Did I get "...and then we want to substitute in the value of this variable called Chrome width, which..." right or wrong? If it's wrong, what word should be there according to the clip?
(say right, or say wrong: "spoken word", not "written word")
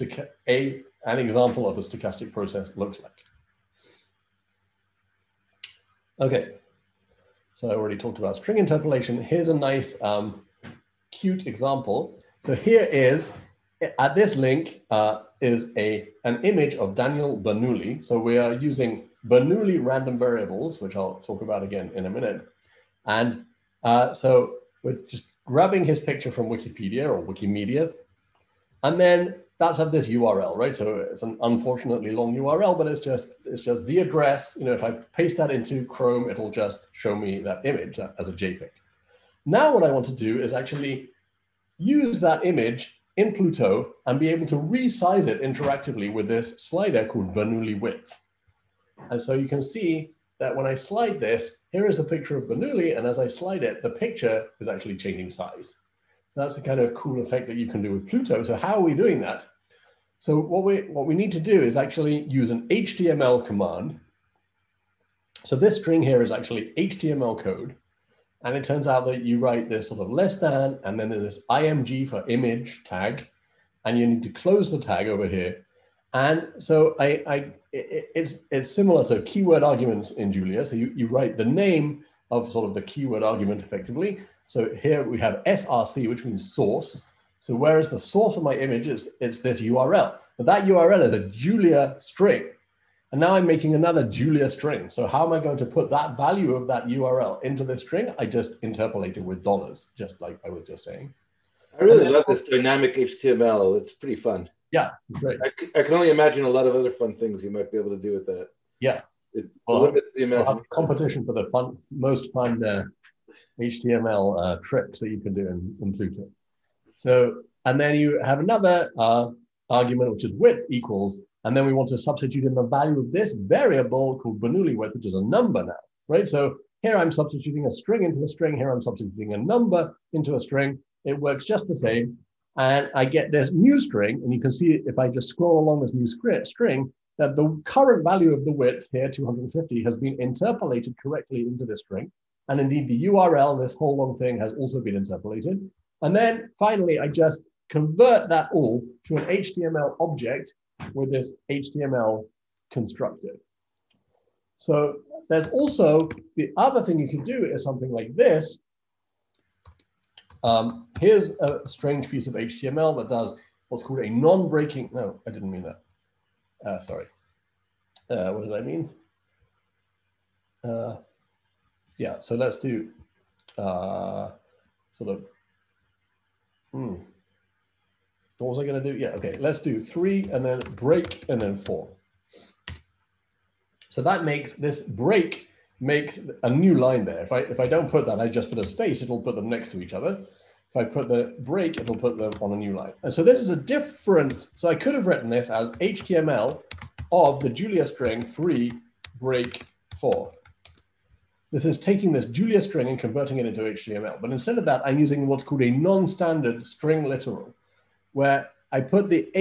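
wrong: "Bernoulli", not "Chrome".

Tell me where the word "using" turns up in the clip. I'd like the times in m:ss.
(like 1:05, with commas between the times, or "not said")
0:18, 3:24.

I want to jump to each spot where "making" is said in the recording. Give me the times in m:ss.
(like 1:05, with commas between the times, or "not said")
1:33.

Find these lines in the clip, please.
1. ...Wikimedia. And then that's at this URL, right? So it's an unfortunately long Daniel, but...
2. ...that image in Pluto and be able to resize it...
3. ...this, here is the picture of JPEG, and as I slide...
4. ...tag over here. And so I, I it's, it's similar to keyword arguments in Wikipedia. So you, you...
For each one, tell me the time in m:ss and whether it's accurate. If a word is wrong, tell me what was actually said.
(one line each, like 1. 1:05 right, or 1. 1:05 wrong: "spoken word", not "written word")
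1. 0:27 wrong: "URL", not "Daniel"
2. 0:42 right
3. 0:51 wrong: "Bernoulli", not "JPEG"
4. 1:14 wrong: "Julia", not "Wikipedia".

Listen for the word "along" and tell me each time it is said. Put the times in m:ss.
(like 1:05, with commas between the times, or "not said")
2:15.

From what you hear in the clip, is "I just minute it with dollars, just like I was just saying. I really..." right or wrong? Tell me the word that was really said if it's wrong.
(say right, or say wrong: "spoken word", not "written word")
wrong: "interpolate", not "minute".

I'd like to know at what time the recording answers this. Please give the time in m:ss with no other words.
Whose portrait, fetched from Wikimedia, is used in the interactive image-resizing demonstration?
0:16.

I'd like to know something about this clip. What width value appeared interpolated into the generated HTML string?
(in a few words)
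250.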